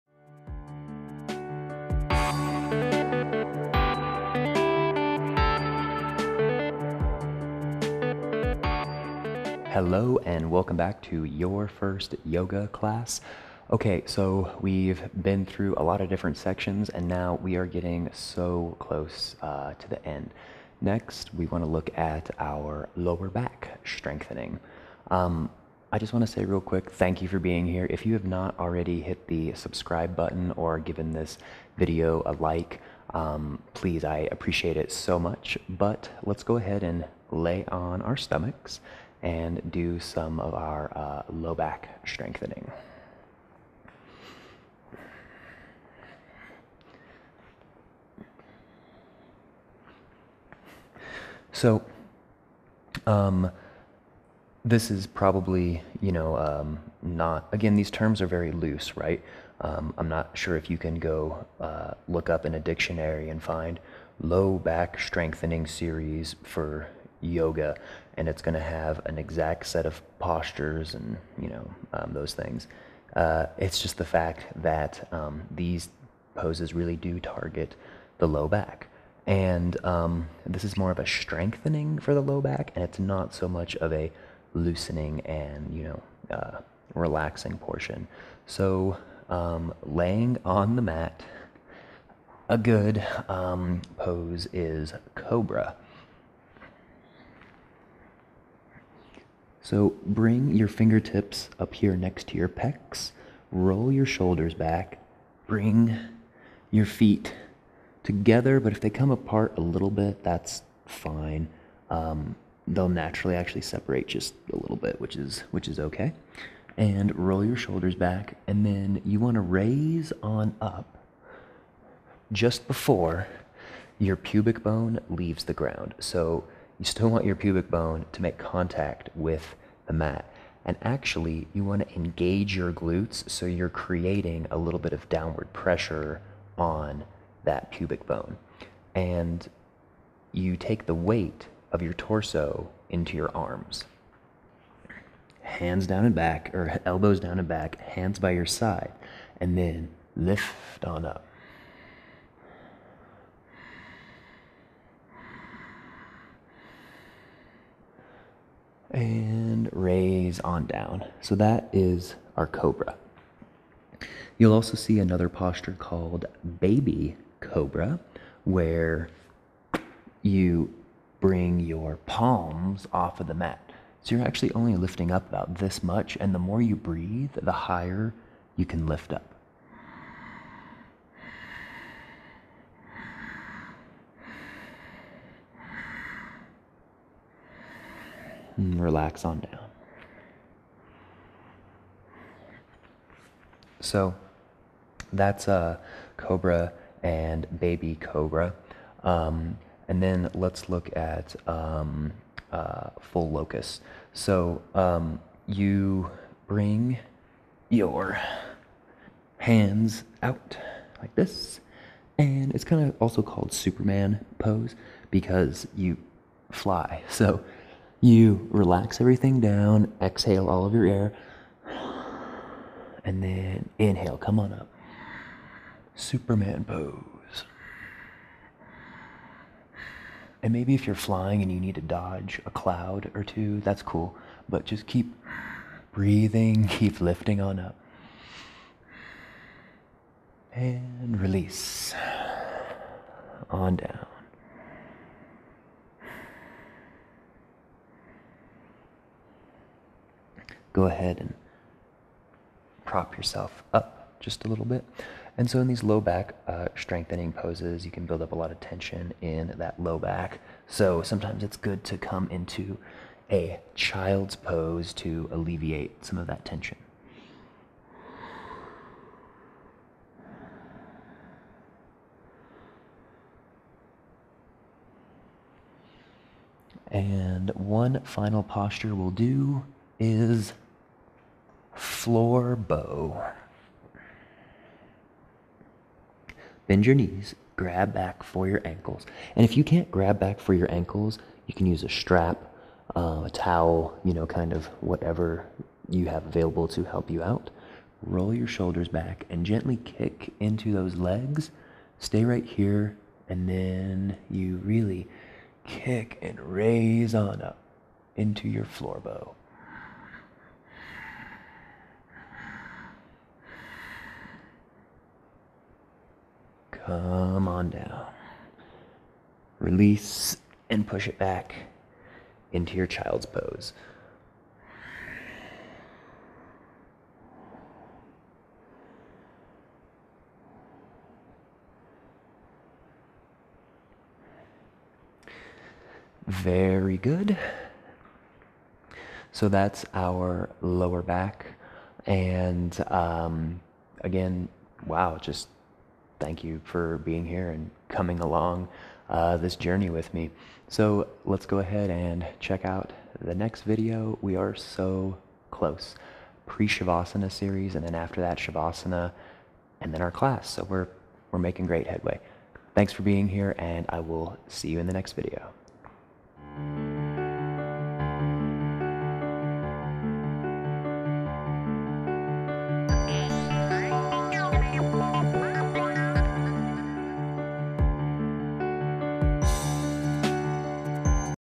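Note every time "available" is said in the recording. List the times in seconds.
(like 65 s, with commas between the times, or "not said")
296 s.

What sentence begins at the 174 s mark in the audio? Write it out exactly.
So you're actually only lifting up about this much, and the more you breathe, the higher you can lift up.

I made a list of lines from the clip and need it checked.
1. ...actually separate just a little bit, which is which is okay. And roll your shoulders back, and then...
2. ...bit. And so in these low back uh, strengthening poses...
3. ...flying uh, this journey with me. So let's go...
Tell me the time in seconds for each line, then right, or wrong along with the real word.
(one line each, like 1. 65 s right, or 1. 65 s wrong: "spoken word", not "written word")
1. 113 s right
2. 254 s right
3. 348 s wrong: "along", not "flying".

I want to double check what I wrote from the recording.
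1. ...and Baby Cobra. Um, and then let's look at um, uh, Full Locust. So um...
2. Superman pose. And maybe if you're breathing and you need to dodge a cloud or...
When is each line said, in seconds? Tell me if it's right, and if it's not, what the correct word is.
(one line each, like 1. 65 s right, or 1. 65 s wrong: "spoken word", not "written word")
1. 197 s right
2. 225 s wrong: "flying", not "breathing".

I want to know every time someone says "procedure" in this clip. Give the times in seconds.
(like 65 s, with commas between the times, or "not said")
not said.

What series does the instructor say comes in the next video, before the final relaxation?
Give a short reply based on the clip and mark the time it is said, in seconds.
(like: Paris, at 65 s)
Pre-Shavasana series, at 356 s.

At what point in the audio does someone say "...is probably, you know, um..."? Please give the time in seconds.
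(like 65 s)
54 s.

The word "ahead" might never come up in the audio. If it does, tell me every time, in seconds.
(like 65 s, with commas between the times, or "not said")
36 s, 250 s, 351 s.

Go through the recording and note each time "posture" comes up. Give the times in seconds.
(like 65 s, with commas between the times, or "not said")
70 s, 165 s, 278 s.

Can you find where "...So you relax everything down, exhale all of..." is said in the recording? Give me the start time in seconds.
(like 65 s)
217 s.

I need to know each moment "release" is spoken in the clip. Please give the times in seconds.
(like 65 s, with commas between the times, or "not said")
241 s, 319 s.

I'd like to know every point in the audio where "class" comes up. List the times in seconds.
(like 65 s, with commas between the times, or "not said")
12 s, 360 s.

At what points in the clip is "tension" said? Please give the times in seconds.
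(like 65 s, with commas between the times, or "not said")
258 s, 266 s.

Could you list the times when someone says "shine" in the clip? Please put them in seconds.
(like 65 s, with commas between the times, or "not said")
not said.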